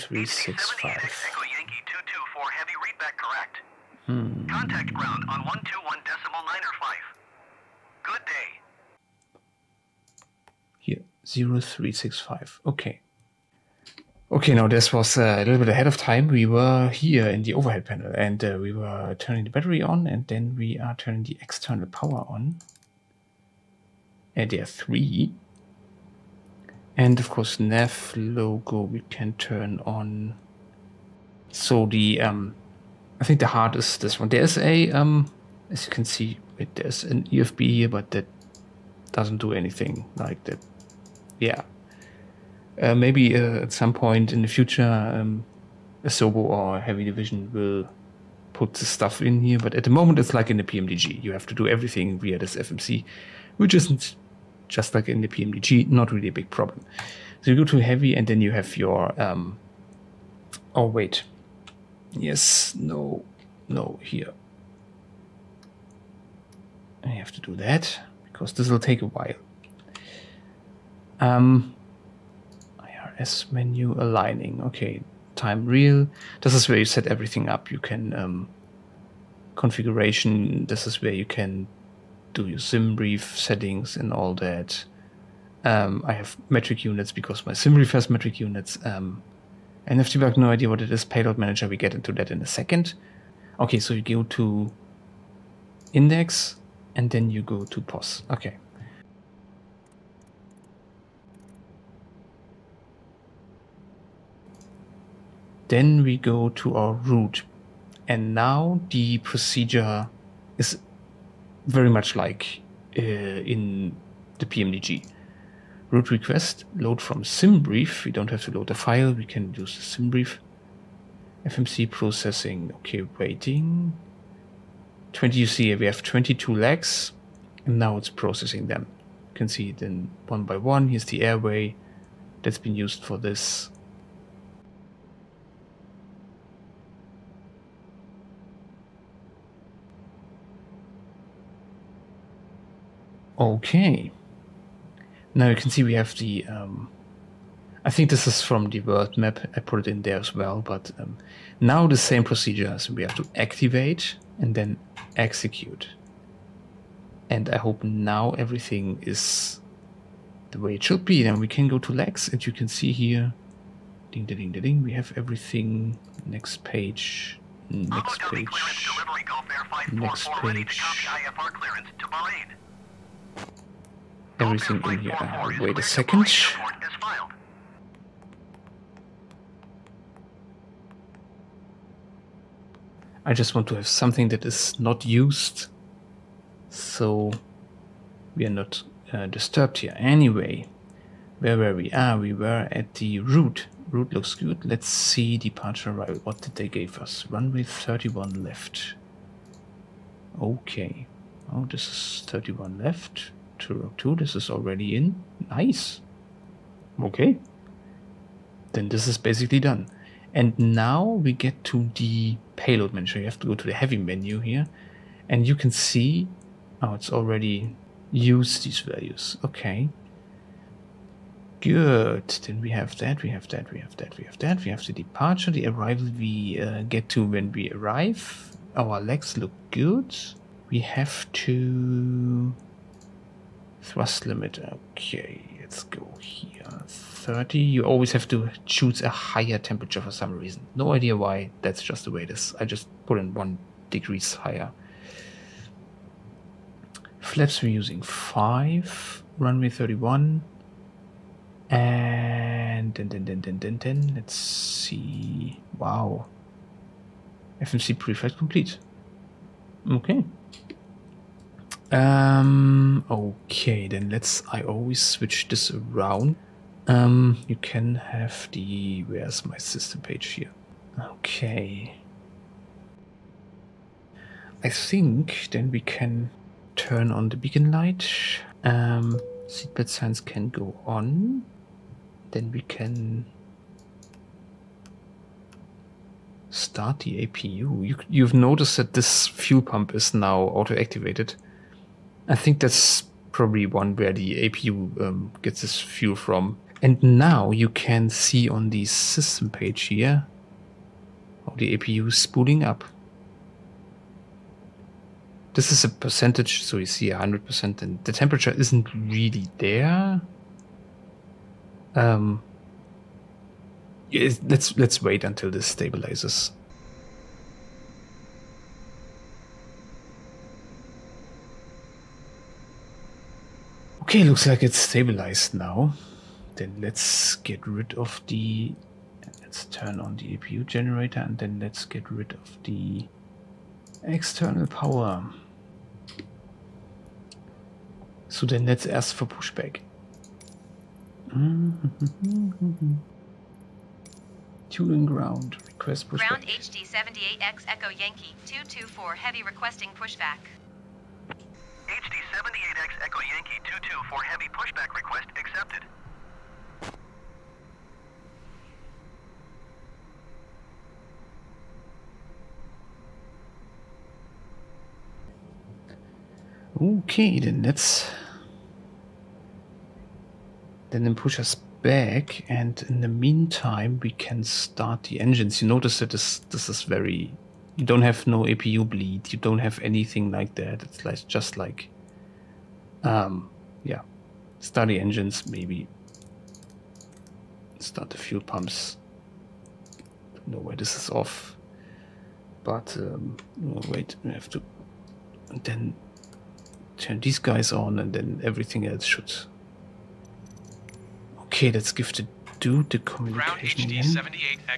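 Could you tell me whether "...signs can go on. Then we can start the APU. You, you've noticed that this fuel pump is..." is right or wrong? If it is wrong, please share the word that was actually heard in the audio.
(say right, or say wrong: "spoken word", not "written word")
right.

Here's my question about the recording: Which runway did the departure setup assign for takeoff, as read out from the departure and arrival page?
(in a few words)
31 left.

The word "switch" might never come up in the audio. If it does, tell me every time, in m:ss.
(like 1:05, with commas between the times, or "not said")
4:25.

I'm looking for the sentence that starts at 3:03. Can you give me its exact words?
I just want to have something that is not used, so we are not uh, disturbed here.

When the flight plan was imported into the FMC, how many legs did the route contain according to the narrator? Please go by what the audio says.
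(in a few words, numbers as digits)
22.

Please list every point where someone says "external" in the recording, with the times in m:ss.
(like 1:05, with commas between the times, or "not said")
0:21, 5:34.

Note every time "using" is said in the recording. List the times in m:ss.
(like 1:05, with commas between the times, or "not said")
4:07.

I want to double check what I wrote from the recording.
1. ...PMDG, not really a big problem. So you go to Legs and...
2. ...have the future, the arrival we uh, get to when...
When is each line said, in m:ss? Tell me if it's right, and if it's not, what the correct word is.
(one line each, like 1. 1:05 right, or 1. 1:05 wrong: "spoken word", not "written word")
1. 0:55 wrong: "Heavy", not "Legs"
2. 3:44 wrong: "departure", not "future".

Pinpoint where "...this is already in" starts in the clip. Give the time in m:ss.
3:24.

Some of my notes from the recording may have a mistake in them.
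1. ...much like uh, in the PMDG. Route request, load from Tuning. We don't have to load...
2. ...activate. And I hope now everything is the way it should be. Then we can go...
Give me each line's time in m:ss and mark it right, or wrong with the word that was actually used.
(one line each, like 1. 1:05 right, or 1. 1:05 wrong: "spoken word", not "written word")
1. 1:51 wrong: "SimBrief", not "Tuning"
2. 2:35 wrong: "execute", not "activate".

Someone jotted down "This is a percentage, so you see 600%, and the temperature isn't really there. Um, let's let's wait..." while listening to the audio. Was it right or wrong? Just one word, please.
wrong.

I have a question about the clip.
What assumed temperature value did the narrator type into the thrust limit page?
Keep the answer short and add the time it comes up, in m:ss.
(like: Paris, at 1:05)
30, at 3:56.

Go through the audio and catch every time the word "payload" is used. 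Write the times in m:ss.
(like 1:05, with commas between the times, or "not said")
1:31, 3:32.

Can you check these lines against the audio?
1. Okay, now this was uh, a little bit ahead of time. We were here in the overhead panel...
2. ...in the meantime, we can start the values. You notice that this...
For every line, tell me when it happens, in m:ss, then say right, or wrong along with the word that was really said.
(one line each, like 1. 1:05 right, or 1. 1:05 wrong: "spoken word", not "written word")
1. 0:14 right
2. 6:12 wrong: "engines", not "values".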